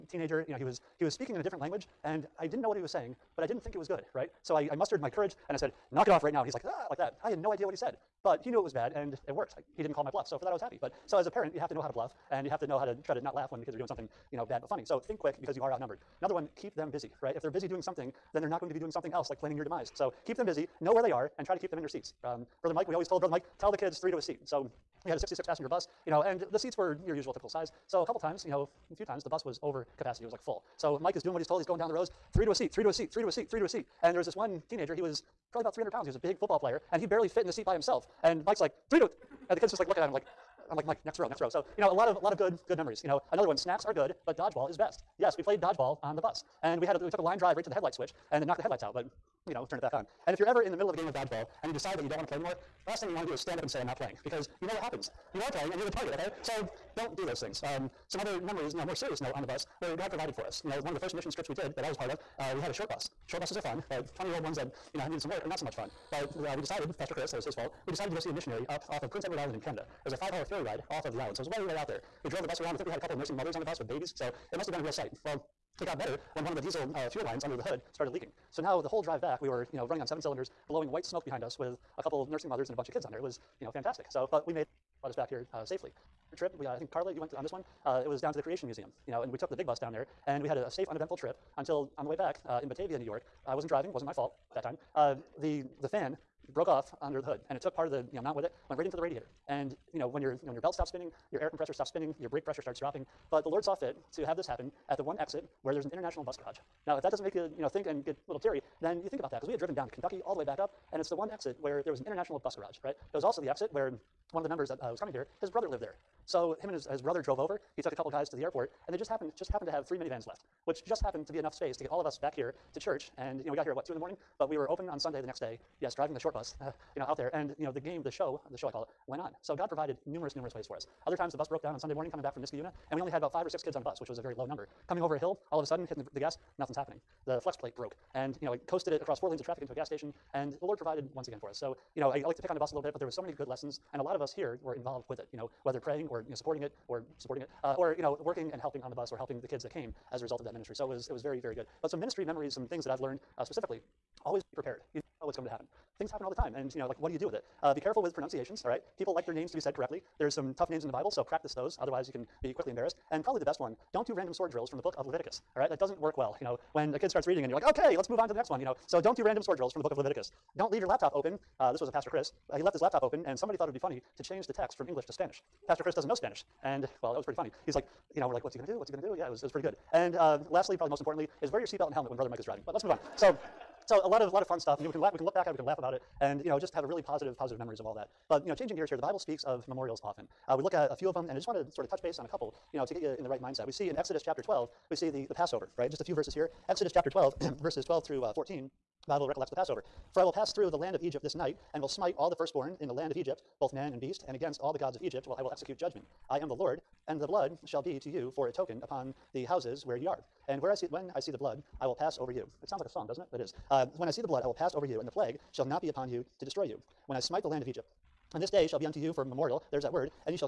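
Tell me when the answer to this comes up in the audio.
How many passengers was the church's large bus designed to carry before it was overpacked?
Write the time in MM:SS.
00:25.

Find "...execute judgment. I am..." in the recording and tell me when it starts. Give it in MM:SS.
03:25.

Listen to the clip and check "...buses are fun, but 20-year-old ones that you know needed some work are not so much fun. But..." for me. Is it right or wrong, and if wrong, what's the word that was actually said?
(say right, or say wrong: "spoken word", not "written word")
right.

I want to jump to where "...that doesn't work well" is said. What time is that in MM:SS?
02:45.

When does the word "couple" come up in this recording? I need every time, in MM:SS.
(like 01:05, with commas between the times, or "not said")
00:28, 01:13, 01:22, 01:57, 03:12.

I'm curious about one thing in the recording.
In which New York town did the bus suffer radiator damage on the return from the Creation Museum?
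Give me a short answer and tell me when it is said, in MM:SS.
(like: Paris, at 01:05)
Batavia, at 01:32.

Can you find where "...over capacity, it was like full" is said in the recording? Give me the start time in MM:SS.
00:29.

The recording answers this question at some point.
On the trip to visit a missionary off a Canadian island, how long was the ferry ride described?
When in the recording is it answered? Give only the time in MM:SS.
01:10.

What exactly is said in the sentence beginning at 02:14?
Coming over a hill, all of a sudden, hitting the, the gas, nothing's happening.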